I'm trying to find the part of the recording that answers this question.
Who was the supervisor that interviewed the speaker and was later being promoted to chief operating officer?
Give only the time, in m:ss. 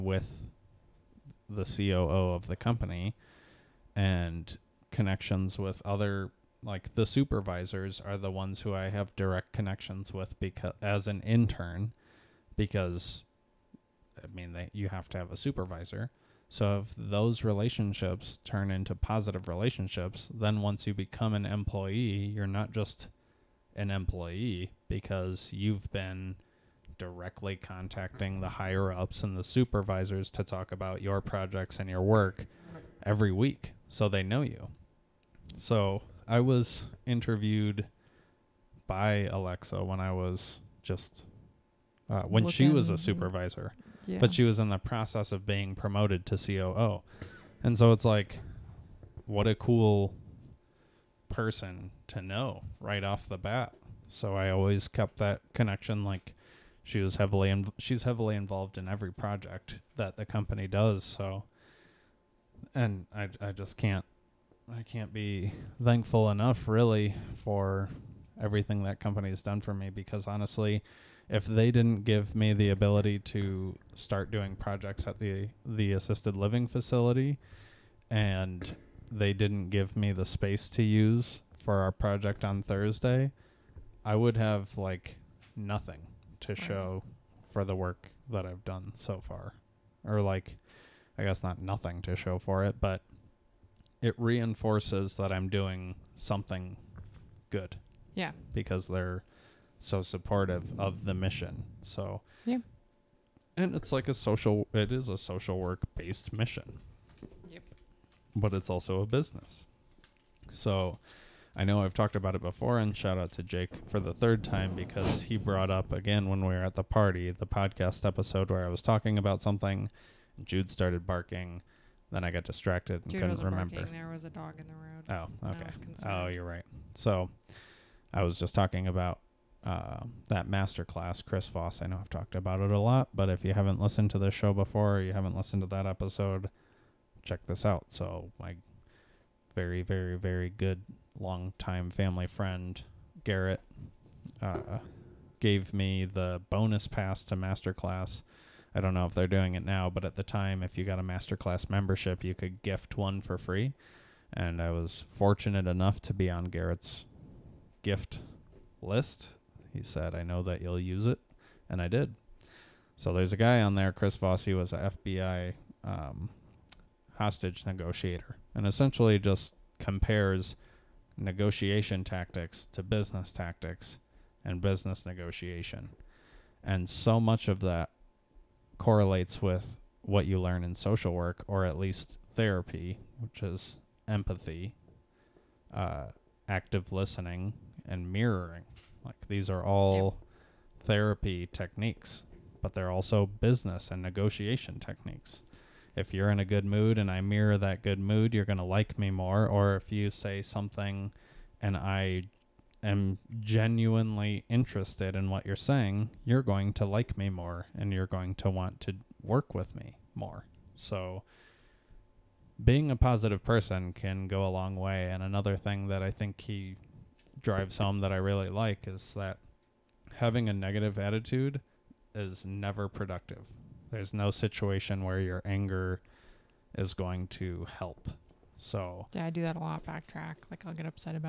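0:39.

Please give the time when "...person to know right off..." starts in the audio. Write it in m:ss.
0:51.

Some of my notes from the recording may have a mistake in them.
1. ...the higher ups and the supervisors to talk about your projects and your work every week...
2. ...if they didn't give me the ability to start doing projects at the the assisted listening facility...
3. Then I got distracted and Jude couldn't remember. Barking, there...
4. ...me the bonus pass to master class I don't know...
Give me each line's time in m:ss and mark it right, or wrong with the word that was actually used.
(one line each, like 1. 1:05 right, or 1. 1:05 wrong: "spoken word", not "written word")
1. 0:28 right
2. 1:11 wrong: "living", not "listening"
3. 2:02 right
4. 2:25 right.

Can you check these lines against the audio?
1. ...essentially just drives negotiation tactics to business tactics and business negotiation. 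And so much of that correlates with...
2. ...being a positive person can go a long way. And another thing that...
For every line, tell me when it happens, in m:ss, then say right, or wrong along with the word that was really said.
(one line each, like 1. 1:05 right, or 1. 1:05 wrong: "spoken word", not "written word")
1. 2:48 wrong: "compares", not "drives"
2. 3:32 right.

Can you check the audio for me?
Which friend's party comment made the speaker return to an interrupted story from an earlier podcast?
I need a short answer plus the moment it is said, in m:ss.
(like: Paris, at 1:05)
Jake, at 1:53.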